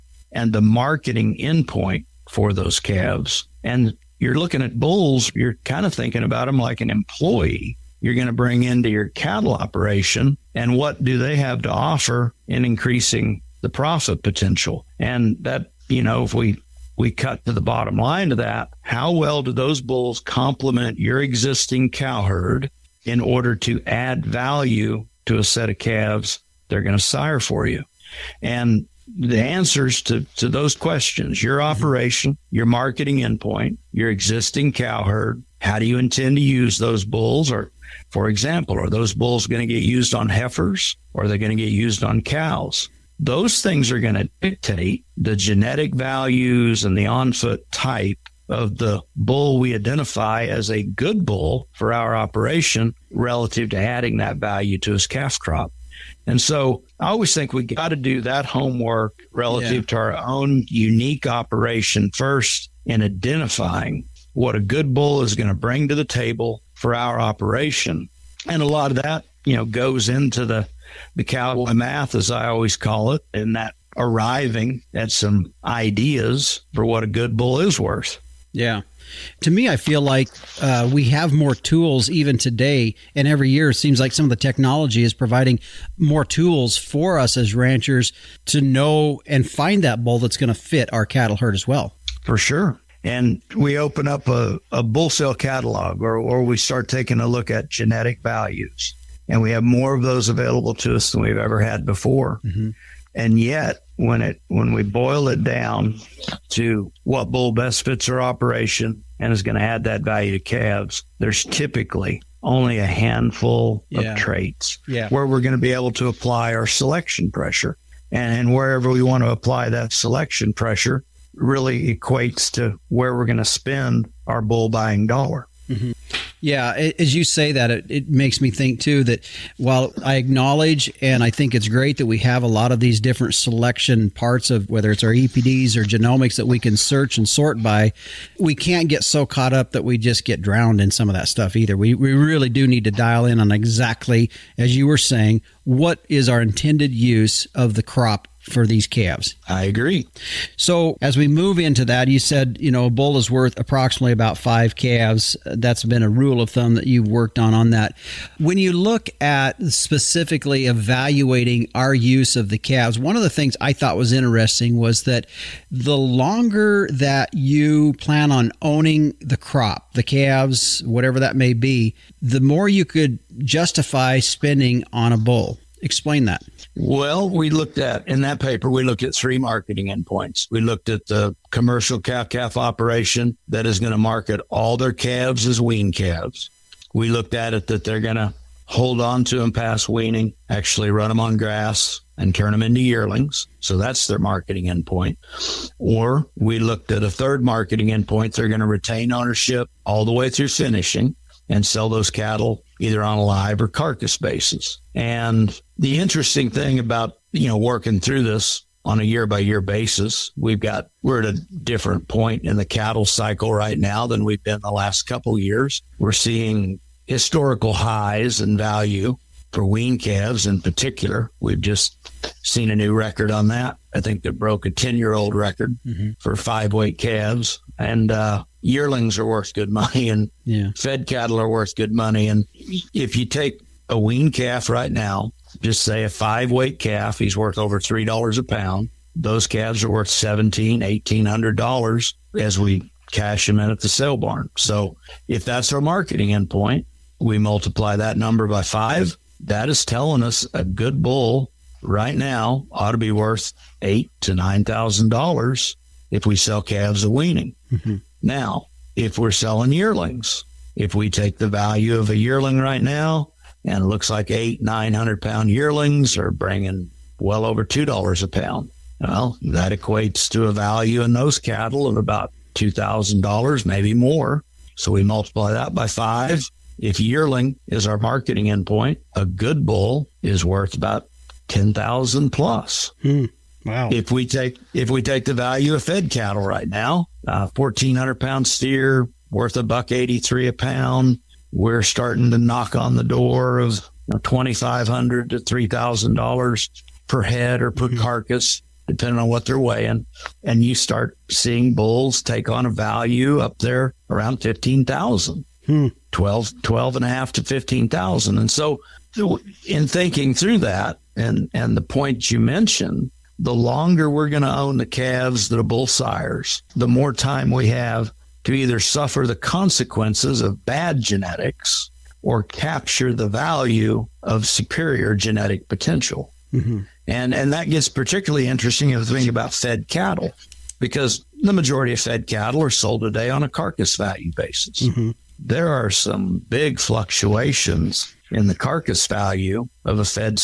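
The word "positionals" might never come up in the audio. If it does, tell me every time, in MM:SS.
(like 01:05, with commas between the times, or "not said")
not said.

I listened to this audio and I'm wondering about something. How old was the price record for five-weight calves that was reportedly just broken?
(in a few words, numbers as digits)
10 year old.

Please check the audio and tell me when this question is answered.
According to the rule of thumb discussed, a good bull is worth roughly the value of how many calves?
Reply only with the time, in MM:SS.
02:34.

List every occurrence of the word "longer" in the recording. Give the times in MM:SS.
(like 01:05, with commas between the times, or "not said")
02:45, 05:13.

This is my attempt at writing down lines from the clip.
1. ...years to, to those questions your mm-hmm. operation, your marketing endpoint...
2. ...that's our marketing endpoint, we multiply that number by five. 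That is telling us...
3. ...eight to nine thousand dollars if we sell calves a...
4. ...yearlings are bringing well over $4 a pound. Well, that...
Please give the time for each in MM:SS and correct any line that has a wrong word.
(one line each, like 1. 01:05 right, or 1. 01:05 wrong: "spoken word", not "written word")
1. 00:29 wrong: "answers", not "years"
2. 04:05 right
3. 04:13 right
4. 04:25 wrong: "2", not "4".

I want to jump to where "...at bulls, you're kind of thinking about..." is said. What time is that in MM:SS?
00:04.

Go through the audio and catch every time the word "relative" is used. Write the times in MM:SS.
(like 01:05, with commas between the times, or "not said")
00:53, 00:59.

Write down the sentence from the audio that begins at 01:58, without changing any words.
And, and wherever we want to apply that selection pressure really equates to where we're going to spend our bull buying dollar.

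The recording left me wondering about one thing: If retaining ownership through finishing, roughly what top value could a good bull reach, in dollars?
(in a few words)
$15,000.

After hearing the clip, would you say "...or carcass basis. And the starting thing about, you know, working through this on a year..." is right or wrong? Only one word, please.
wrong.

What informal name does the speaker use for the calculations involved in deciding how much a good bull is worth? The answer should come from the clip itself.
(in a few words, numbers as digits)
cowboy math.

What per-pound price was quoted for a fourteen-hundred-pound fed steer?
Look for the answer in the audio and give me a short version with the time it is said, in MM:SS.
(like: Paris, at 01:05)
$1.83, at 04:49.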